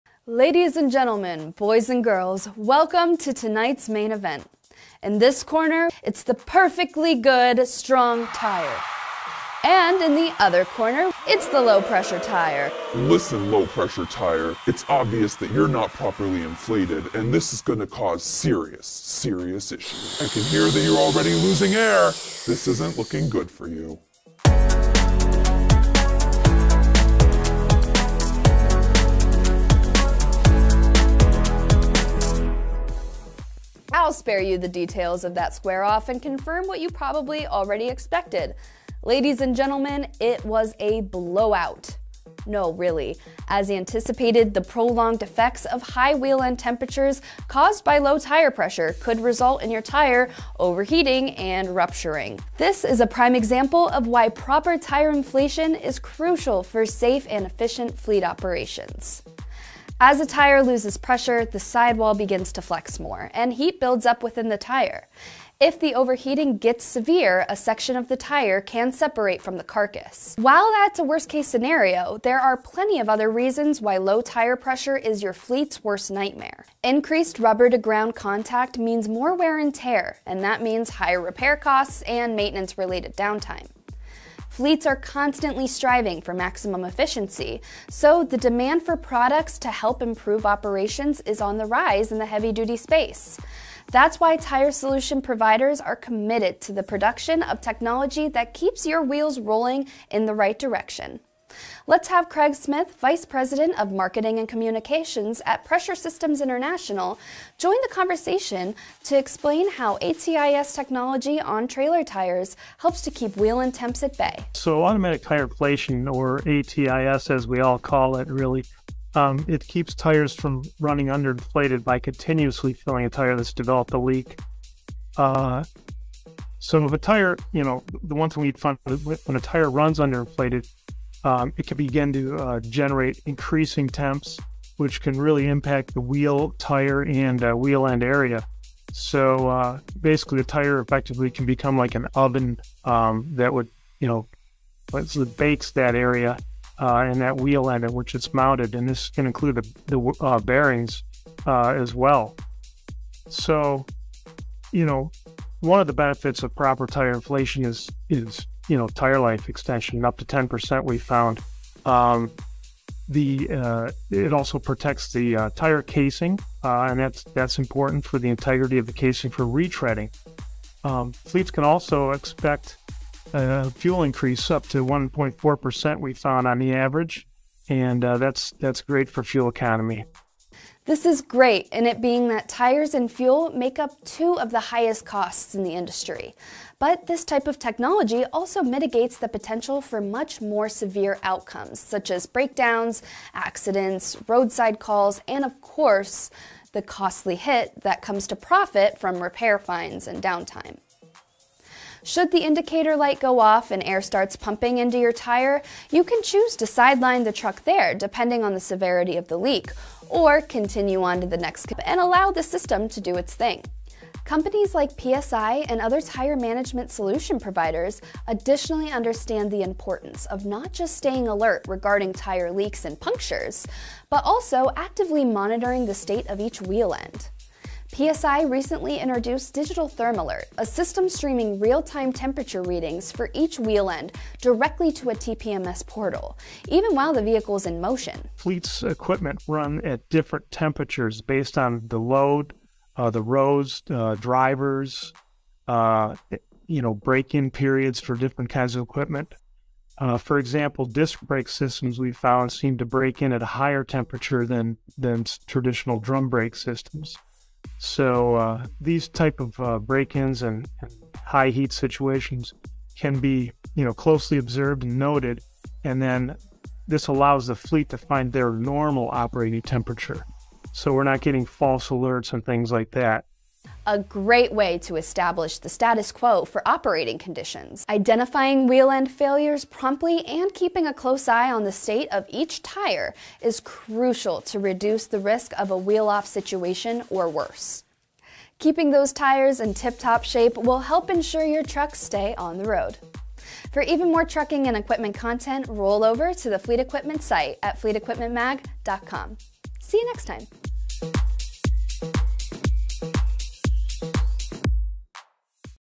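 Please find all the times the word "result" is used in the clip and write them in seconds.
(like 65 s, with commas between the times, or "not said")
49 s.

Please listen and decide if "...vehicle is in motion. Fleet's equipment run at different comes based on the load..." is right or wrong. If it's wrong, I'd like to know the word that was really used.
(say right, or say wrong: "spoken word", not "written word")
wrong: "temperatures", not "comes".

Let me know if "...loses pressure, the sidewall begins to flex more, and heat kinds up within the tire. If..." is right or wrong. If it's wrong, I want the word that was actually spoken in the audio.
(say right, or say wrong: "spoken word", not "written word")
wrong: "builds", not "kinds".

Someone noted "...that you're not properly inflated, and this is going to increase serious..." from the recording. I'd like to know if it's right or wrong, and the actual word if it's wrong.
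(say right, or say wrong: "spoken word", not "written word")
wrong: "cause", not "increase".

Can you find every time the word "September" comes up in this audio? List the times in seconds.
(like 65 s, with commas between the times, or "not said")
not said.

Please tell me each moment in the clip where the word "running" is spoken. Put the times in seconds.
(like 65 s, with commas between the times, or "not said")
120 s.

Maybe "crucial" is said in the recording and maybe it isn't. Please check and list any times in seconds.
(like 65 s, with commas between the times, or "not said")
55 s, 283 s.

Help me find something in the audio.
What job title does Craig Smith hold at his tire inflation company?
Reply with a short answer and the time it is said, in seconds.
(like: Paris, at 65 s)
Vice President of Marketing and Communications, at 102 s.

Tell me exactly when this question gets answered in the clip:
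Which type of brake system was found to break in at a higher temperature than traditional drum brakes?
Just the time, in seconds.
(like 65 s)
250 s.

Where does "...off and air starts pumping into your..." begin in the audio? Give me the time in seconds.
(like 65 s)
203 s.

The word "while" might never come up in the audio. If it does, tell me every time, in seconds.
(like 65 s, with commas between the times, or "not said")
70 s, 236 s.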